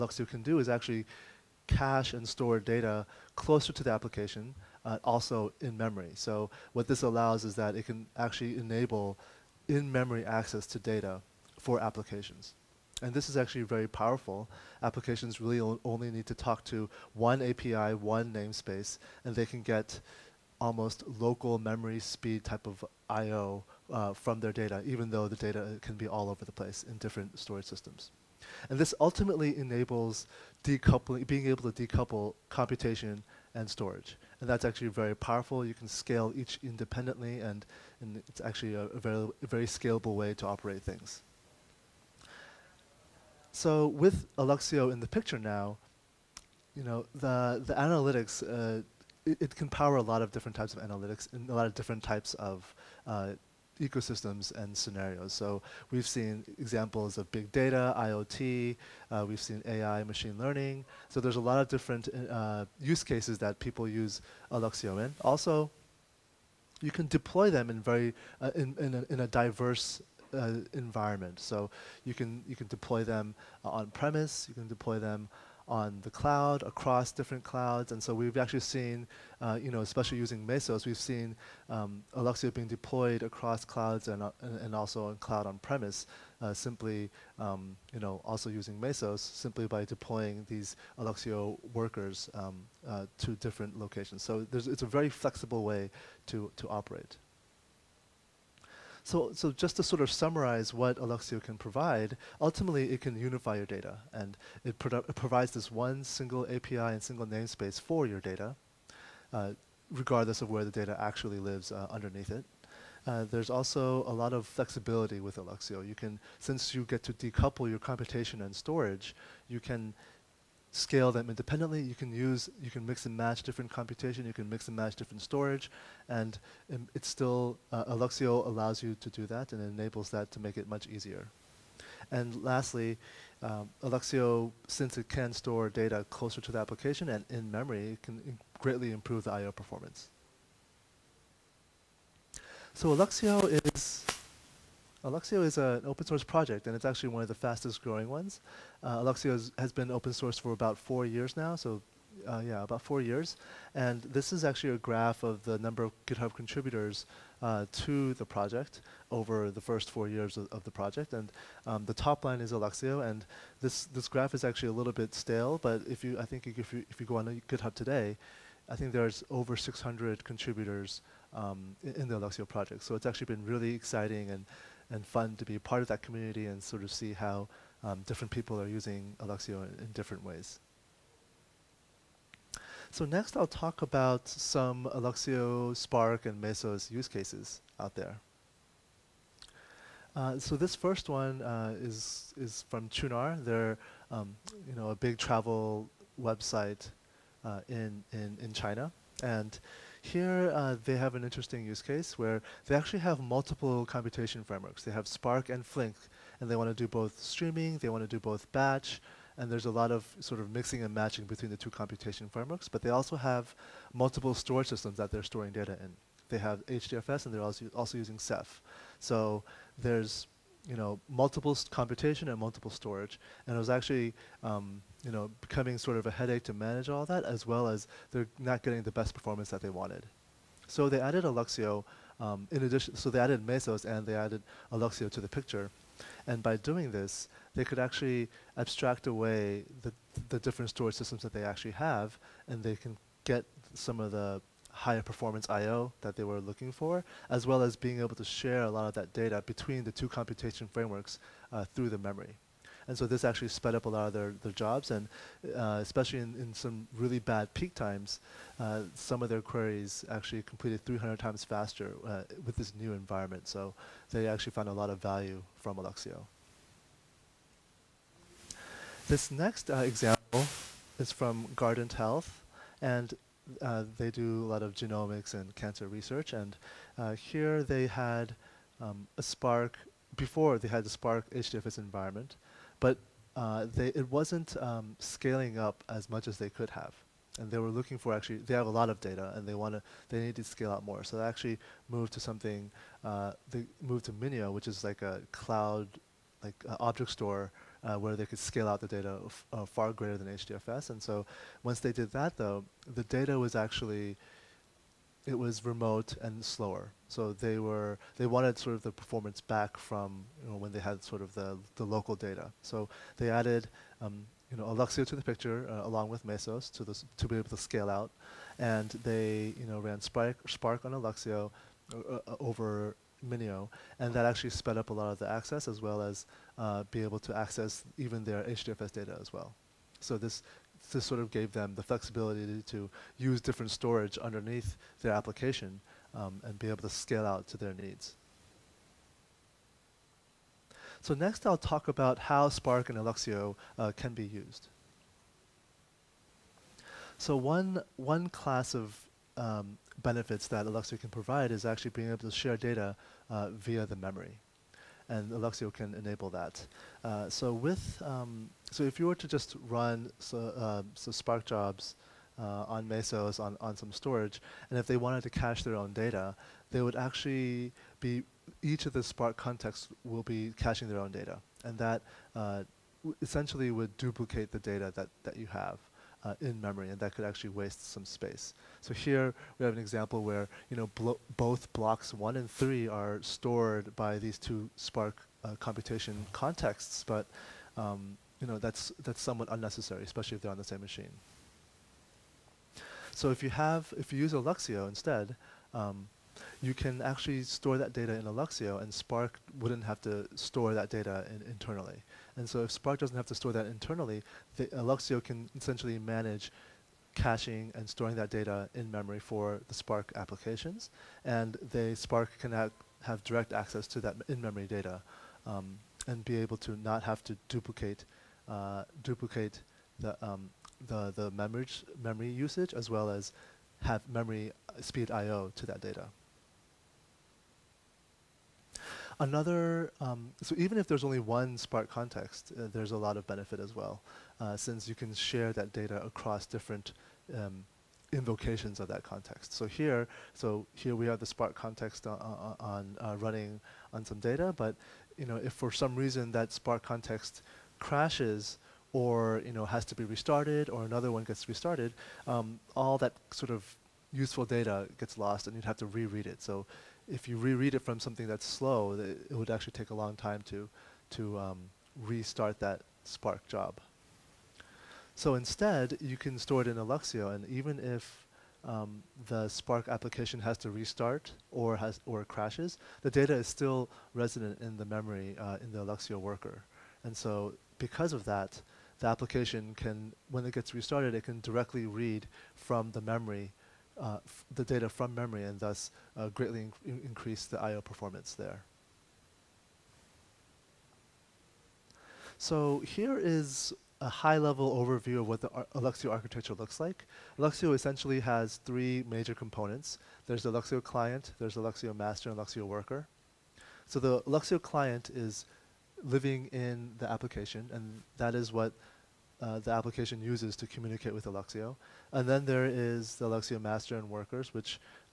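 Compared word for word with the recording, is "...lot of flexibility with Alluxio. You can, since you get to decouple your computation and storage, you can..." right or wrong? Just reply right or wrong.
right.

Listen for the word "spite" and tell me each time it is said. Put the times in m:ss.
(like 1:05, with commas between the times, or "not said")
not said.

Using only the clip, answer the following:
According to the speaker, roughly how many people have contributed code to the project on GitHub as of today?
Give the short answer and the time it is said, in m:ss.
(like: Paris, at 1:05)
over 600, at 2:49.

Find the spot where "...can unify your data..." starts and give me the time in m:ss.
1:42.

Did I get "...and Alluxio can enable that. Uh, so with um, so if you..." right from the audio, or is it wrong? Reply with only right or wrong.
right.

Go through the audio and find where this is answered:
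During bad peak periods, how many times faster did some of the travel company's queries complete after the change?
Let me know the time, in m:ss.
4:20.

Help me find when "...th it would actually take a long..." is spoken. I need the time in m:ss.
7:38.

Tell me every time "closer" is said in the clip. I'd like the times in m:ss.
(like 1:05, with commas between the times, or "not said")
0:03, 2:16.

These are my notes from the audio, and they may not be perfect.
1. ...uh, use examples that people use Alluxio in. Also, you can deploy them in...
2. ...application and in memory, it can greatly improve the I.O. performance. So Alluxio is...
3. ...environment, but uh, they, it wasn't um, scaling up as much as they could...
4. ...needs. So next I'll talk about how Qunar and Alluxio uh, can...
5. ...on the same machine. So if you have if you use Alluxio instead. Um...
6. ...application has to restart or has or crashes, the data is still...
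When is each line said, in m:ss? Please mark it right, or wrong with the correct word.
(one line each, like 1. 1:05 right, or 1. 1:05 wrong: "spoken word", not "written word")
1. 1:02 wrong: "cases", not "examples"
2. 2:16 right
3. 4:41 right
4. 5:37 wrong: "Spark", not "Qunar"
5. 6:30 right
6. 7:49 right.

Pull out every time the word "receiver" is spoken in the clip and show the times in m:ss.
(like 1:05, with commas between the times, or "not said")
not said.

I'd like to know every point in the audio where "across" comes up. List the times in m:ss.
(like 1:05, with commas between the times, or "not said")
1:16, 1:23, 7:16.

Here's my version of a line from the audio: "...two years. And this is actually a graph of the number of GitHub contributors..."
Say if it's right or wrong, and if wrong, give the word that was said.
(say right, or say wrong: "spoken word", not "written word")
wrong: "four", not "two".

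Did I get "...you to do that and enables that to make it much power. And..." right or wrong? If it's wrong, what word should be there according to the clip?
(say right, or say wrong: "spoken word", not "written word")
wrong: "easier", not "power".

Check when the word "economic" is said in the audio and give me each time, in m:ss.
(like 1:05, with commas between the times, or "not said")
not said.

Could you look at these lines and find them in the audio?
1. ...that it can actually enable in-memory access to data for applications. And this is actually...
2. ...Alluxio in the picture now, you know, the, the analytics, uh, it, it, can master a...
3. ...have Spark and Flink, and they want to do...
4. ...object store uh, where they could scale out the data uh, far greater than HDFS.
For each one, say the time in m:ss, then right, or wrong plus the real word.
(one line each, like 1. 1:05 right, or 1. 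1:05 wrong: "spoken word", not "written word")
1. 0:07 right
2. 0:44 wrong: "power", not "master"
3. 3:24 right
4. 4:56 right.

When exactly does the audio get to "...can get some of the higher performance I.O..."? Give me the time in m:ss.
4:02.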